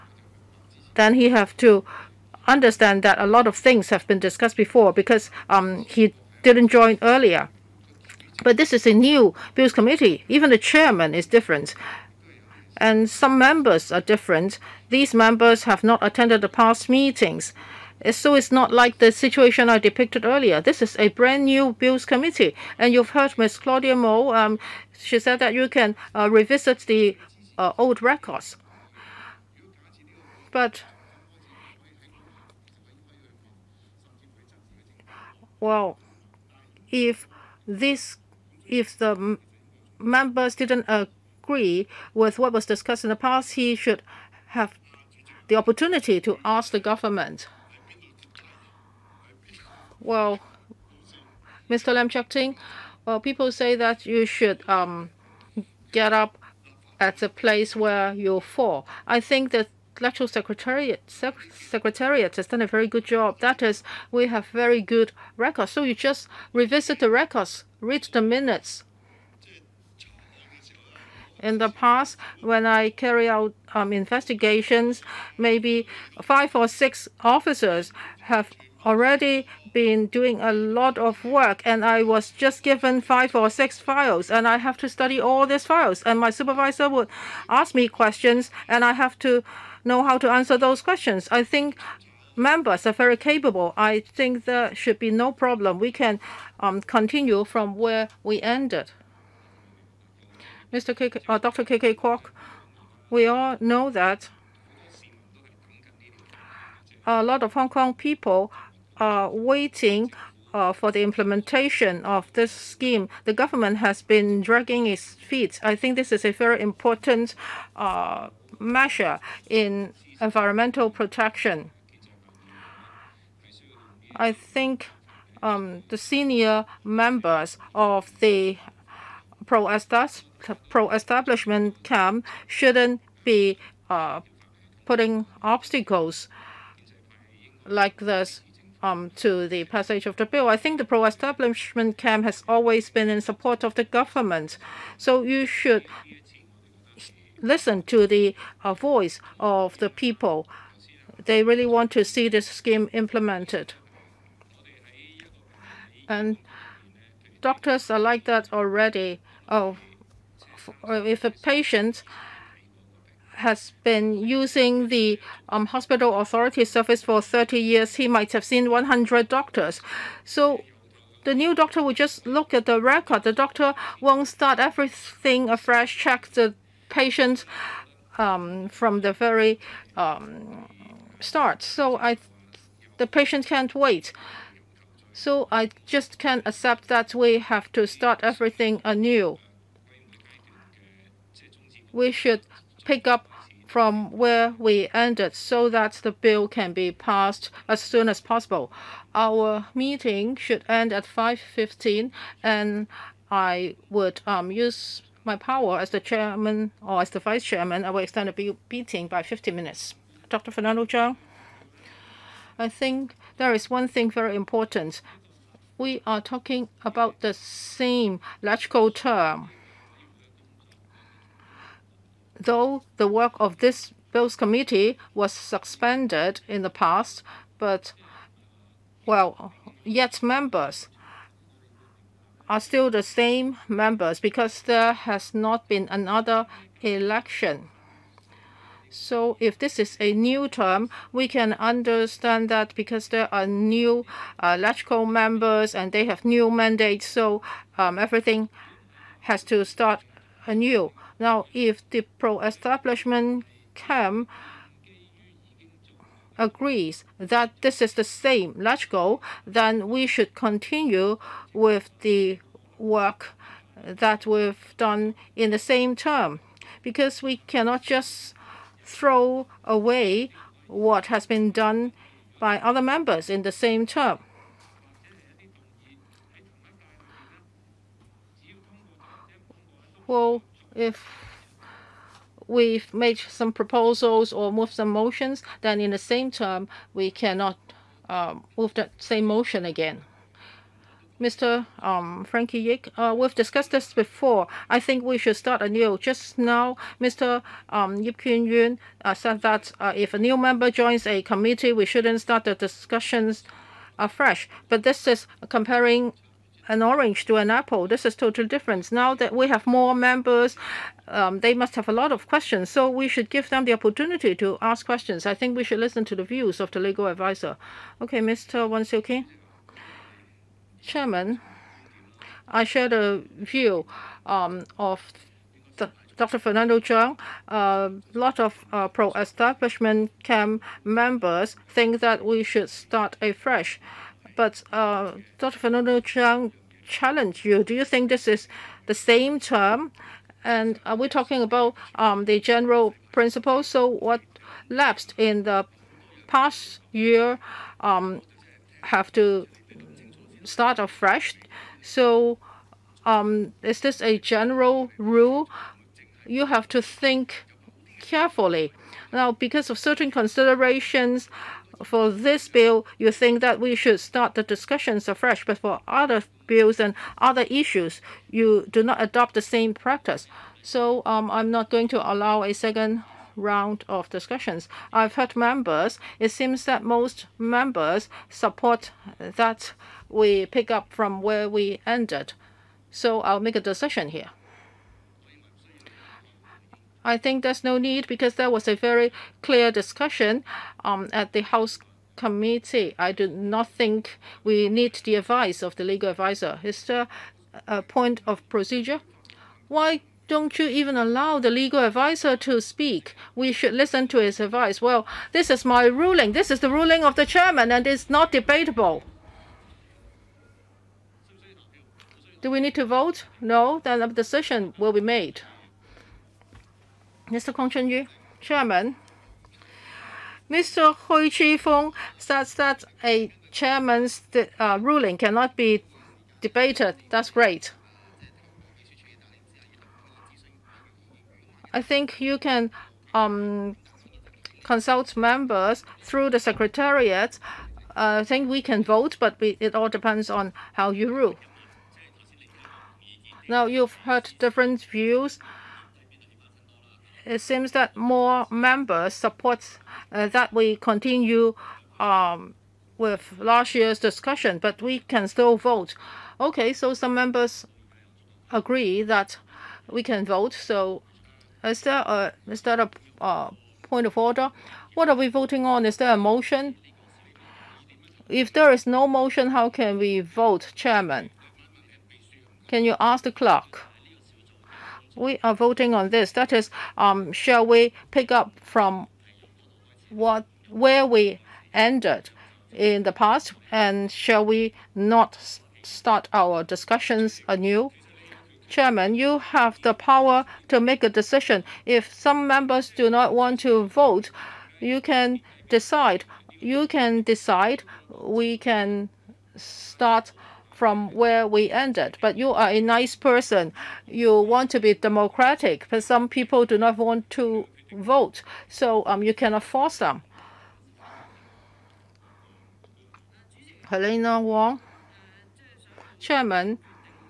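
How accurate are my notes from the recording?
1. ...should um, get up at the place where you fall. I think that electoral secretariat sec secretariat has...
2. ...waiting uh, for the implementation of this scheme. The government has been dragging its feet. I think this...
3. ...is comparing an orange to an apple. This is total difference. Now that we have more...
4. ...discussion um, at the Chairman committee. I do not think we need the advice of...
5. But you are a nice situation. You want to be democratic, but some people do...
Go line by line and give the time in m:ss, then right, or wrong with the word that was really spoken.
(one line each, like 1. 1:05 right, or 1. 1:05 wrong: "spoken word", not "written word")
1. 0:54 right
2. 1:49 right
3. 5:05 right
4. 6:29 wrong: "House", not "Chairman"
5. 8:22 wrong: "person", not "situation".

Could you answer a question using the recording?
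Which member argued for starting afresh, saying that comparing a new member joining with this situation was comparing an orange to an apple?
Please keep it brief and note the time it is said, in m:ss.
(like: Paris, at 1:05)
Frankie Yick, at 4:51.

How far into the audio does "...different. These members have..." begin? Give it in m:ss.
0:13.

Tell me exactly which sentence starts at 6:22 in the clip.
So I'll make a decision here.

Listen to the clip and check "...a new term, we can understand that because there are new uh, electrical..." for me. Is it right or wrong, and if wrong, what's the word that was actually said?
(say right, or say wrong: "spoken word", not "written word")
right.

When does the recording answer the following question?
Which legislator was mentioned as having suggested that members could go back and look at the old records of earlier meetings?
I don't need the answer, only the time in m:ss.
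0:23.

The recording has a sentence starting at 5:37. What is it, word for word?
Do you think this is the same term?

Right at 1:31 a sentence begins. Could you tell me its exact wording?
I think members are very capable.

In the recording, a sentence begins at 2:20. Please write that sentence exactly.
I think the pro-establishment camp has always been in support of the government.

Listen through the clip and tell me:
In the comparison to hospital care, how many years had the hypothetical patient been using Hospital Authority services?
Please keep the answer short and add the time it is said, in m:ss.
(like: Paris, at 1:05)
30, at 2:47.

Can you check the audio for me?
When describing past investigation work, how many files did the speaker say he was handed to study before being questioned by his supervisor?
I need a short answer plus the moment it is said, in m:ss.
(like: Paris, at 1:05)
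5 or 6, at 1:23.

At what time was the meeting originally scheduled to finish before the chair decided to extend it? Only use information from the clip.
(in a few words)
5:15.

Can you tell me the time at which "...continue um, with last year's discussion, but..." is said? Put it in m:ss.
7:30.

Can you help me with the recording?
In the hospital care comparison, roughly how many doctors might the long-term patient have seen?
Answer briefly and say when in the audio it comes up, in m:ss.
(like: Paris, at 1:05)
100, at 2:48.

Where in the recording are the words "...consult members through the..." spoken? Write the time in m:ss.
7:14.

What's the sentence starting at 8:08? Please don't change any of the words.
Chairman, you have the power to make a decision.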